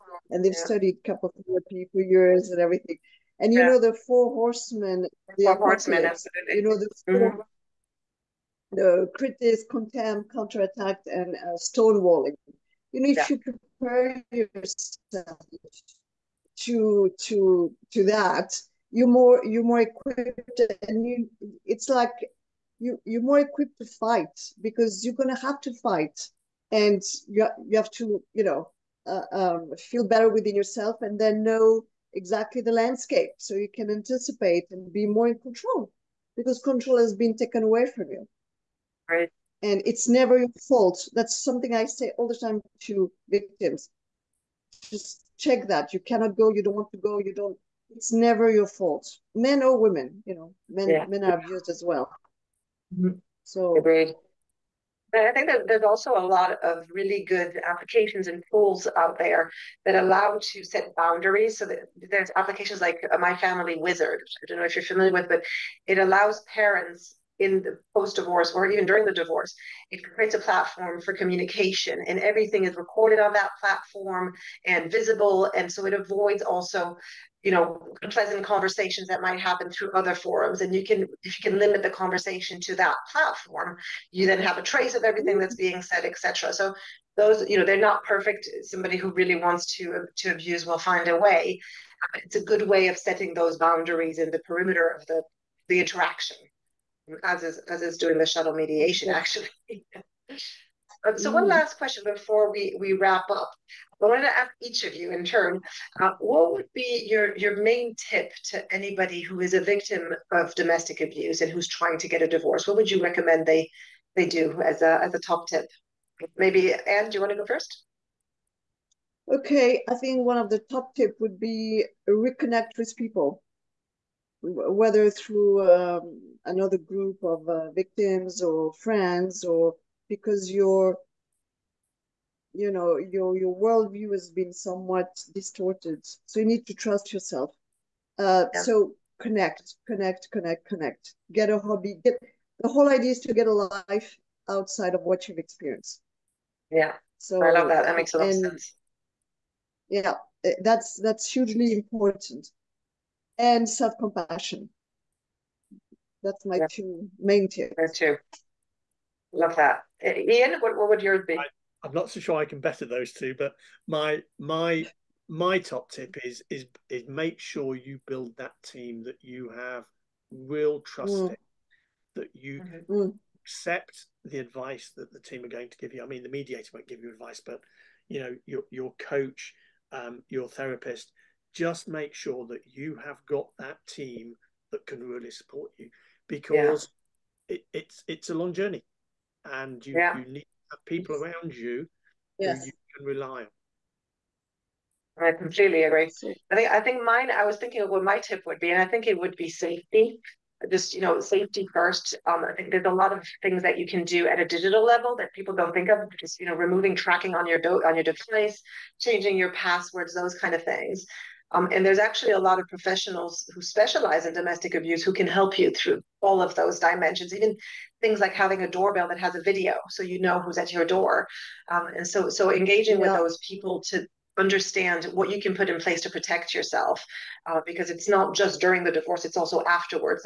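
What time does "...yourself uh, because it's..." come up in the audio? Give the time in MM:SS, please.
03:46.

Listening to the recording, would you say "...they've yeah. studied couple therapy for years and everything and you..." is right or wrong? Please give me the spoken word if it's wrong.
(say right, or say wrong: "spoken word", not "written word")
right.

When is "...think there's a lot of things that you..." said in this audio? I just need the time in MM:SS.
03:22.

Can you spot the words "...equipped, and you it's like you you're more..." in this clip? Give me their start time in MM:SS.
00:19.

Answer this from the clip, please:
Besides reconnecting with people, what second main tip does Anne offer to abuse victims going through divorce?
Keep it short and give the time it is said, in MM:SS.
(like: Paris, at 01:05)
Self compassion, at 02:33.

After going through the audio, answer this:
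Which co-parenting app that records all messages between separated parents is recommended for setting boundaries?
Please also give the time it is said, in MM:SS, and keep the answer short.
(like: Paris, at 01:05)
My Family Wizard, at 01:03.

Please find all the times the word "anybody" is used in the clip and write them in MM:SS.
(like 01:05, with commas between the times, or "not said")
01:48.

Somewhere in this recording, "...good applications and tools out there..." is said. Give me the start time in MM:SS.
00:57.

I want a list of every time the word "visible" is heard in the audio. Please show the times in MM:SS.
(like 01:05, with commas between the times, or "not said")
01:14.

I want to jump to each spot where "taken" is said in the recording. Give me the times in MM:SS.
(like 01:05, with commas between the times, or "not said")
00:37.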